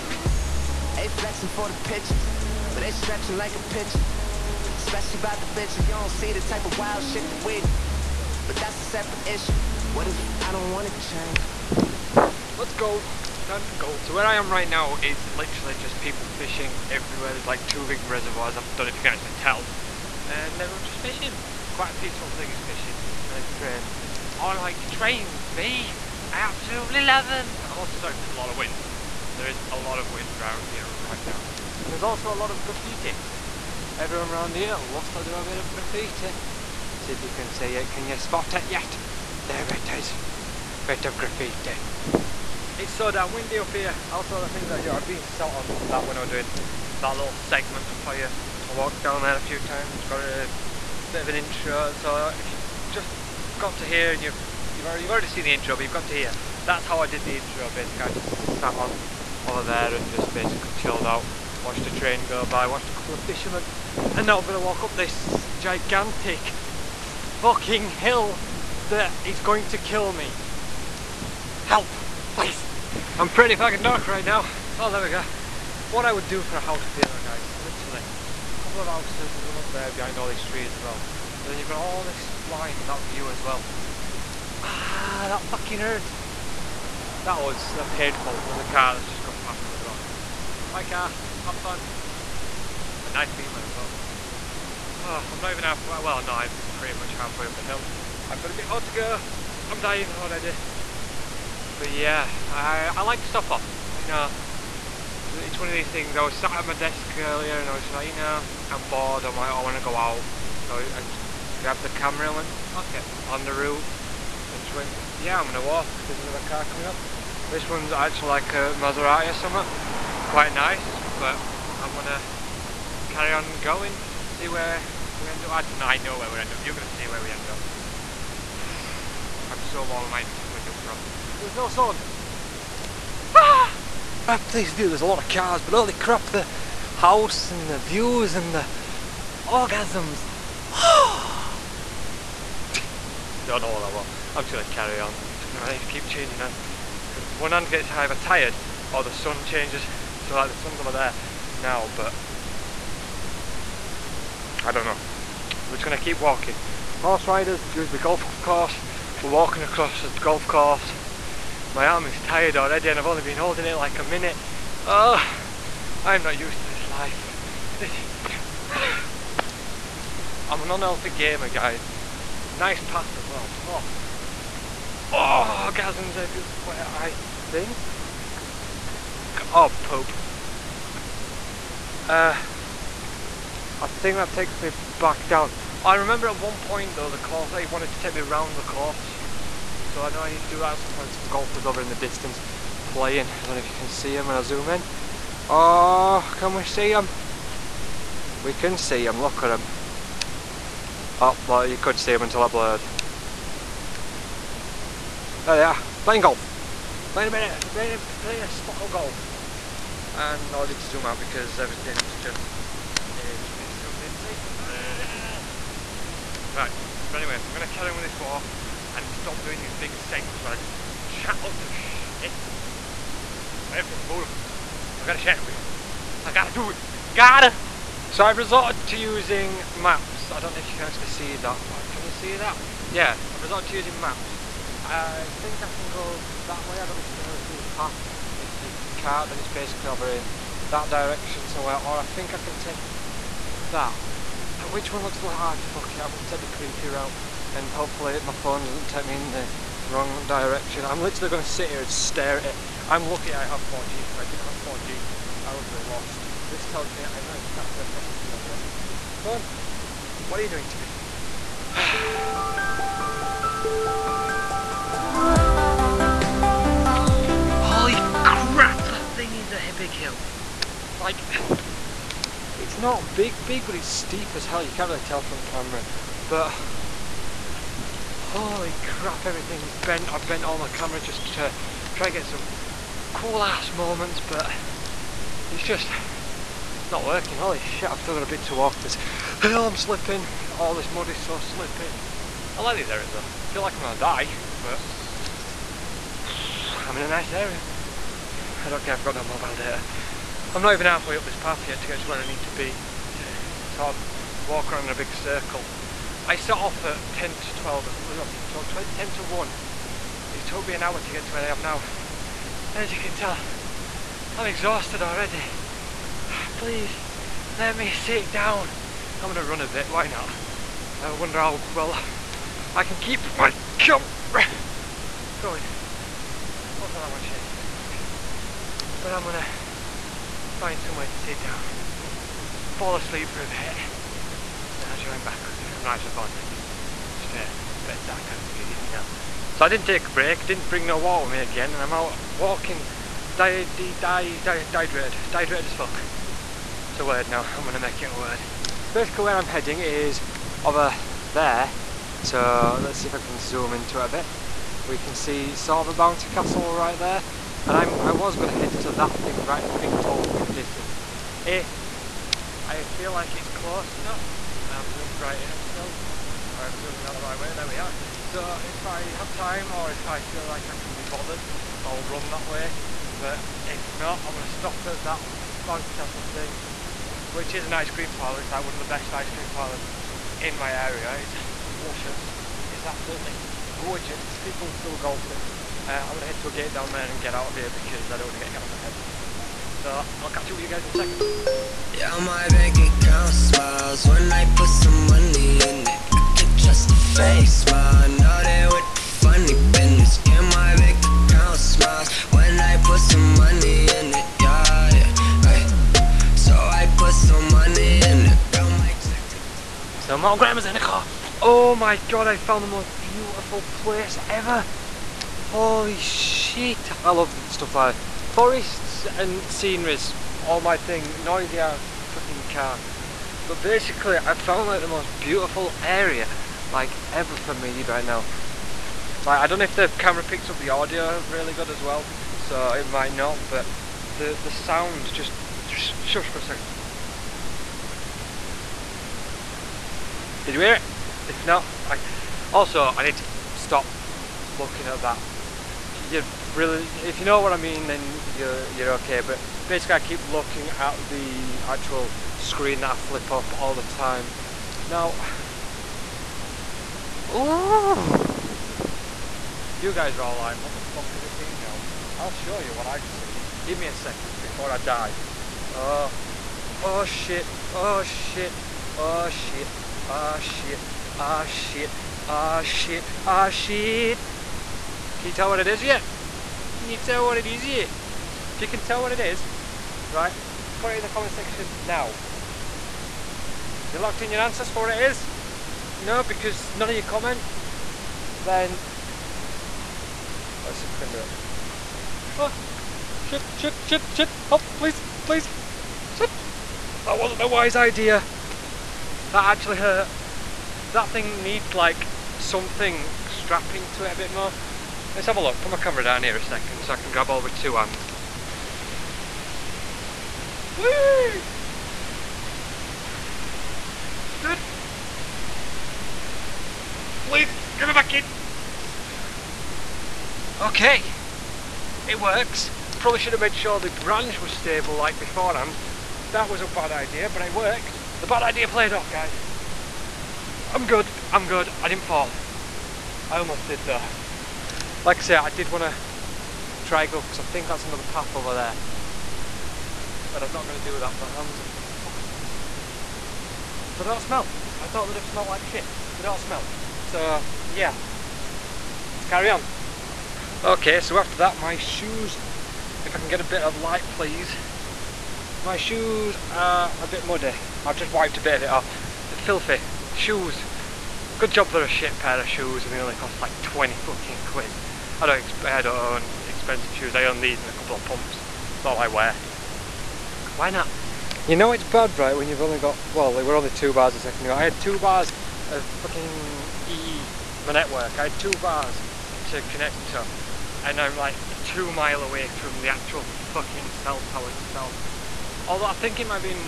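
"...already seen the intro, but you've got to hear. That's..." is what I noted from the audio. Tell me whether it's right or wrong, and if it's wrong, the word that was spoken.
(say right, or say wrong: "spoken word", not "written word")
right.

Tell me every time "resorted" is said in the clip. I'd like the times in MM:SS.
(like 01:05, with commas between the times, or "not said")
03:48, 03:53.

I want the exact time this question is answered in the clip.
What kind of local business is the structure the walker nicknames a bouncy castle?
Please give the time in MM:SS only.
06:17.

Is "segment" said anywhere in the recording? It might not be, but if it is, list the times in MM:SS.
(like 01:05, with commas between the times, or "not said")
00:47, 03:39.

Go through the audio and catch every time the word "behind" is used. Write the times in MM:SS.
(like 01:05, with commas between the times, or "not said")
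01:19.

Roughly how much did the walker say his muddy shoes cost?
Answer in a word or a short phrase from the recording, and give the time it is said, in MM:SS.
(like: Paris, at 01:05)
20 quid, at 09:23.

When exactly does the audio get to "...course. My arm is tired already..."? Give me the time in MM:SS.
02:40.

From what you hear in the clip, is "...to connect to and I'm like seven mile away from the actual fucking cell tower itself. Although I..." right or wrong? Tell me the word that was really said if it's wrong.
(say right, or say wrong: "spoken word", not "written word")
wrong: "two", not "seven".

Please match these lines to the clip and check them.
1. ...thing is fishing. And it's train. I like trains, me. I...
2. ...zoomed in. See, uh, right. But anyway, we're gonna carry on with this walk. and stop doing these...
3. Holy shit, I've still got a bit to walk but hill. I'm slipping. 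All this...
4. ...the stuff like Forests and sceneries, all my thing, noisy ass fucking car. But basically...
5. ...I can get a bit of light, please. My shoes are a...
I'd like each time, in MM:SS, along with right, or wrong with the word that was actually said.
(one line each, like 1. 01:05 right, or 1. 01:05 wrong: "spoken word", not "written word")
1. 00:22 right
2. 03:33 right
3. 04:47 right
4. 06:57 right
5. 09:13 right.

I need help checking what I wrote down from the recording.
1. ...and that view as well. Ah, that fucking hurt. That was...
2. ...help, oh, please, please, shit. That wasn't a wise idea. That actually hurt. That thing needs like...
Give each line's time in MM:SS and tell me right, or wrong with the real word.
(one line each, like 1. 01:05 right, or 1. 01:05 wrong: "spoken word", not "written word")
1. 01:22 right
2. 08:14 right.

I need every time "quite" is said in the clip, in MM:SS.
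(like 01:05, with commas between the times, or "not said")
00:21, 02:00.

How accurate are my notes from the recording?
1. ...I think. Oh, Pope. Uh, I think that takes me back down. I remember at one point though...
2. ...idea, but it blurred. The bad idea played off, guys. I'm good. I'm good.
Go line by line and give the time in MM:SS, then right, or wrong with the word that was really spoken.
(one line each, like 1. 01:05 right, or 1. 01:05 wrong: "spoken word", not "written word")
1. 02:56 right
2. 08:46 wrong: "worked", not "blurred".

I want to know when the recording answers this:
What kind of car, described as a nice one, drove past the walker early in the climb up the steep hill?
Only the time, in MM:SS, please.
01:33.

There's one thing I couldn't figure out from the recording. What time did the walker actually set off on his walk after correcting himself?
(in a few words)
10 to 1.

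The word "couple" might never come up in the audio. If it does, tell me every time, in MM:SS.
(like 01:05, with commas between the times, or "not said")
01:02, 01:18, 09:27.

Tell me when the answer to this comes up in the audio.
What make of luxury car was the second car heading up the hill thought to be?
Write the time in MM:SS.
01:58.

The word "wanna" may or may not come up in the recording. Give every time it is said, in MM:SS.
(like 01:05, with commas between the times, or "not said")
00:10.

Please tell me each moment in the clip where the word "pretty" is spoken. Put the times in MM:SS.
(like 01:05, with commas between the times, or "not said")
01:13, 01:36.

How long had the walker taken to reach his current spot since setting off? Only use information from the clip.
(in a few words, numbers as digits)
An hour.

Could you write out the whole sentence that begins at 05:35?
I'm not actually falling asleep, just just a bit of sarcasm for you if you didn't know.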